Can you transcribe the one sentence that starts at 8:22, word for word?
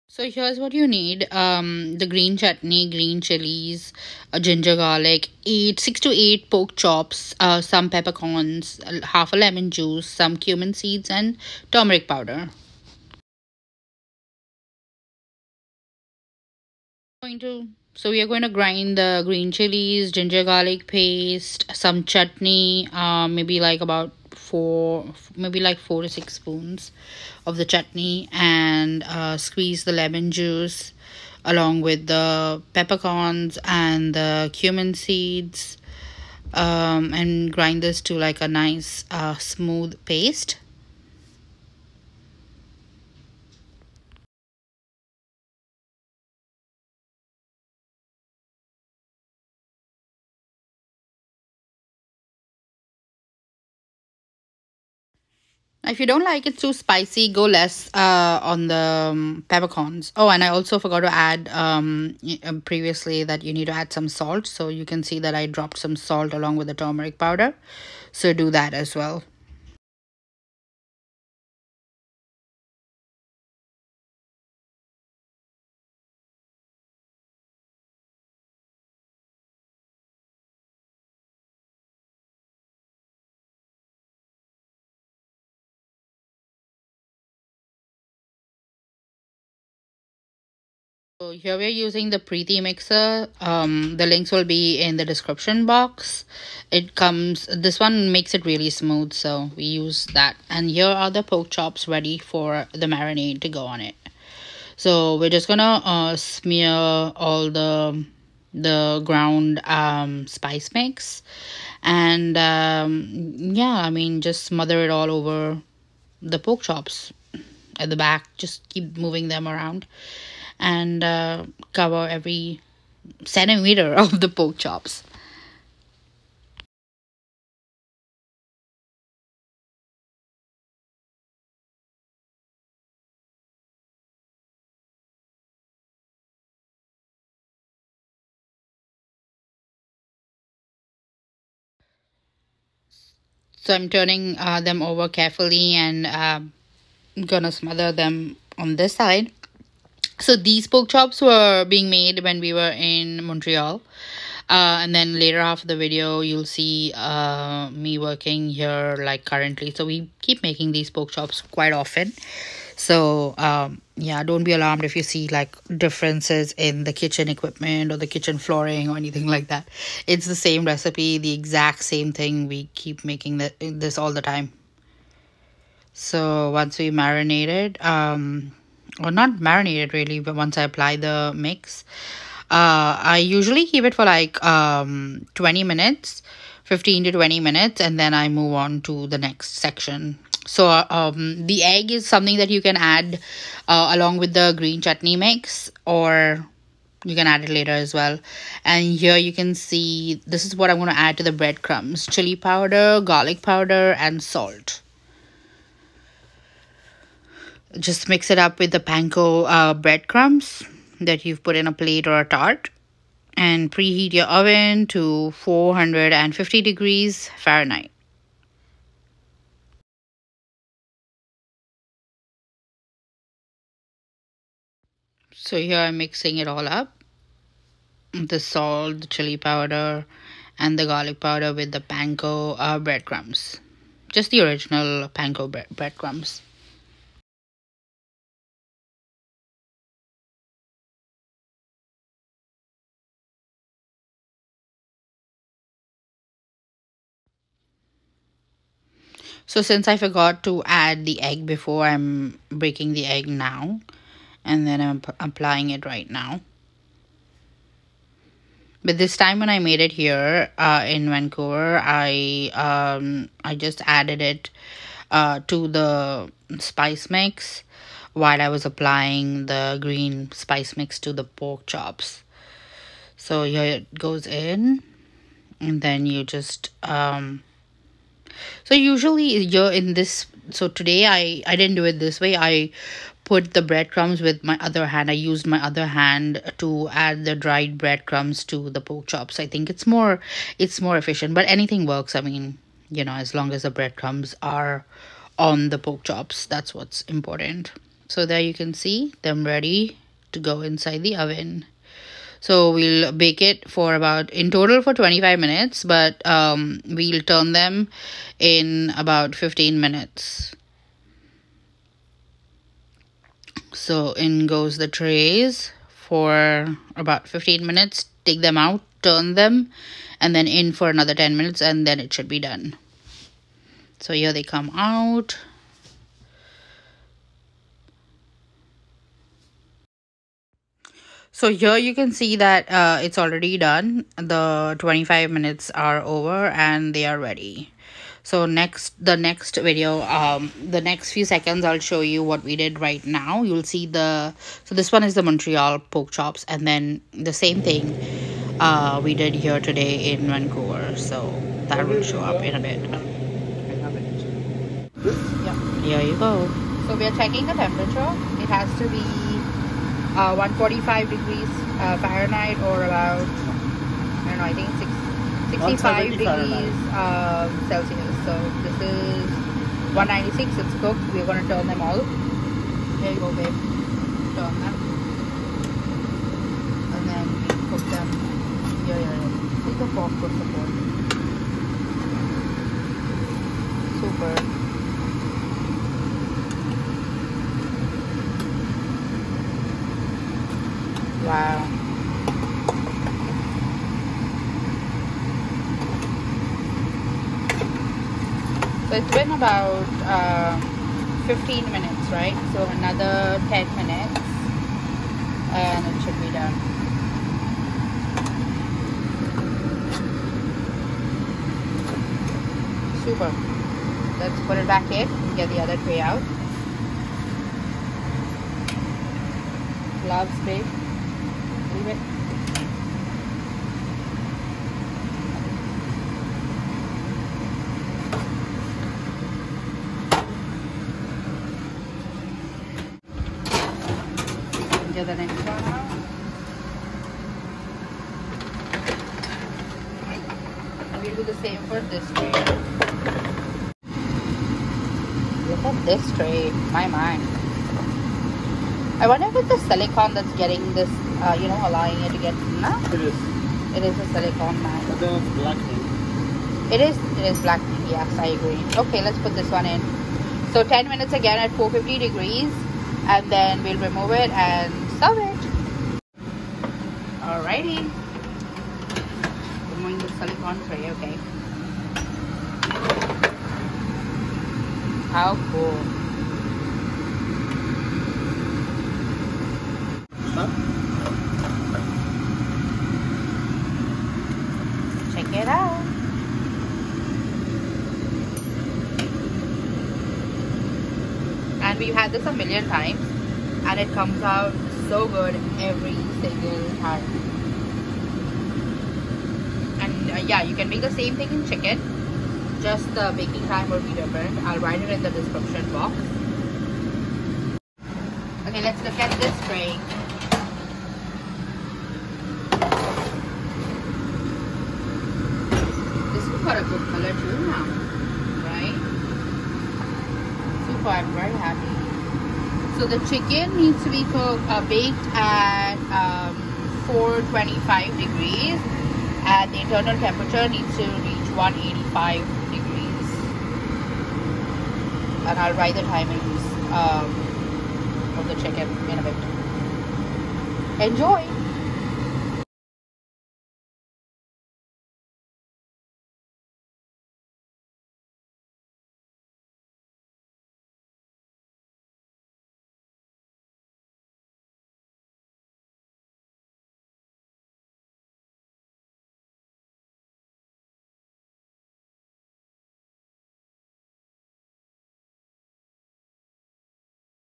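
Just the baking time will be different.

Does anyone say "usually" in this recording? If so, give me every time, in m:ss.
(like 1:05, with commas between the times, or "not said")
3:03, 4:38.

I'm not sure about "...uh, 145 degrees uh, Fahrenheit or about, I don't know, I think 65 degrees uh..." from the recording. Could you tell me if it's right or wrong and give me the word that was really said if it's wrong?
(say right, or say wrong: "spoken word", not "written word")
right.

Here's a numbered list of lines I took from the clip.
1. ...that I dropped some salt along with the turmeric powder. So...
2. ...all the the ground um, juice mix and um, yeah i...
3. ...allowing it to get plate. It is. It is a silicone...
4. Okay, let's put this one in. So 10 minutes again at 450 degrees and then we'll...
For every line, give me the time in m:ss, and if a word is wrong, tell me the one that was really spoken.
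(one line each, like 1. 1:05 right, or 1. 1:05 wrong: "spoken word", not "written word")
1. 1:05 right
2. 1:46 wrong: "spice", not "juice"
3. 7:31 wrong: "matte", not "plate"
4. 7:38 right.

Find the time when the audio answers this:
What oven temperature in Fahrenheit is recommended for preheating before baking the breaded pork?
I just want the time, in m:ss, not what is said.
3:35.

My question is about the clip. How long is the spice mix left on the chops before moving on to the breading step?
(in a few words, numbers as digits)
15 to 20 minutes.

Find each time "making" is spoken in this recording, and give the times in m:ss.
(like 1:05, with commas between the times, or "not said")
2:40, 2:53.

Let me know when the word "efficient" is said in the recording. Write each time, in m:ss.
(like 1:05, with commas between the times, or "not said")
4:50.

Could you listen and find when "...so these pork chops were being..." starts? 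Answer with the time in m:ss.
2:30.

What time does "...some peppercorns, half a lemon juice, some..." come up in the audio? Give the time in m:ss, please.
0:07.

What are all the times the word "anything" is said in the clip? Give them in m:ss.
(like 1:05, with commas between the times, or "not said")
2:48, 4:51.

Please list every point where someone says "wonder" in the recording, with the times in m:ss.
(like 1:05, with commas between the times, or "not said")
7:29.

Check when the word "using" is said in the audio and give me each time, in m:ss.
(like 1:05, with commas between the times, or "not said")
1:31.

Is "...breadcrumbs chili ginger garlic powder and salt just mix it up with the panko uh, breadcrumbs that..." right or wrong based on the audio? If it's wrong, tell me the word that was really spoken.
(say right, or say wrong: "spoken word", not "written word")
wrong: "powder", not "ginger".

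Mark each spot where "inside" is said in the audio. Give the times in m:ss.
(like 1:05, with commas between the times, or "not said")
5:00.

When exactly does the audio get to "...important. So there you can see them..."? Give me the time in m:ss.
4:57.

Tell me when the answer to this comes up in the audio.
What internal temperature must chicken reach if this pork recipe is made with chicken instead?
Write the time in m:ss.
8:51.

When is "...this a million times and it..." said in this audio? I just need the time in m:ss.
8:12.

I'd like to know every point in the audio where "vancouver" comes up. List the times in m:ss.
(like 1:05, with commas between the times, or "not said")
4:21, 5:50.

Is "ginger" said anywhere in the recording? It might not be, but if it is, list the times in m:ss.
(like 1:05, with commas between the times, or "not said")
0:04, 0:20.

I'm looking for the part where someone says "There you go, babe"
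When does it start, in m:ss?
6:11.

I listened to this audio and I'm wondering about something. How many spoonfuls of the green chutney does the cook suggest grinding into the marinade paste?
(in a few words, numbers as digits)
4 to 6.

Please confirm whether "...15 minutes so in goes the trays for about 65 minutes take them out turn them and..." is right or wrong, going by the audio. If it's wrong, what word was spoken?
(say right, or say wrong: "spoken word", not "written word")
wrong: "15", not "65".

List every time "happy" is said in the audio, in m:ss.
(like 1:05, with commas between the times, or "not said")
8:41.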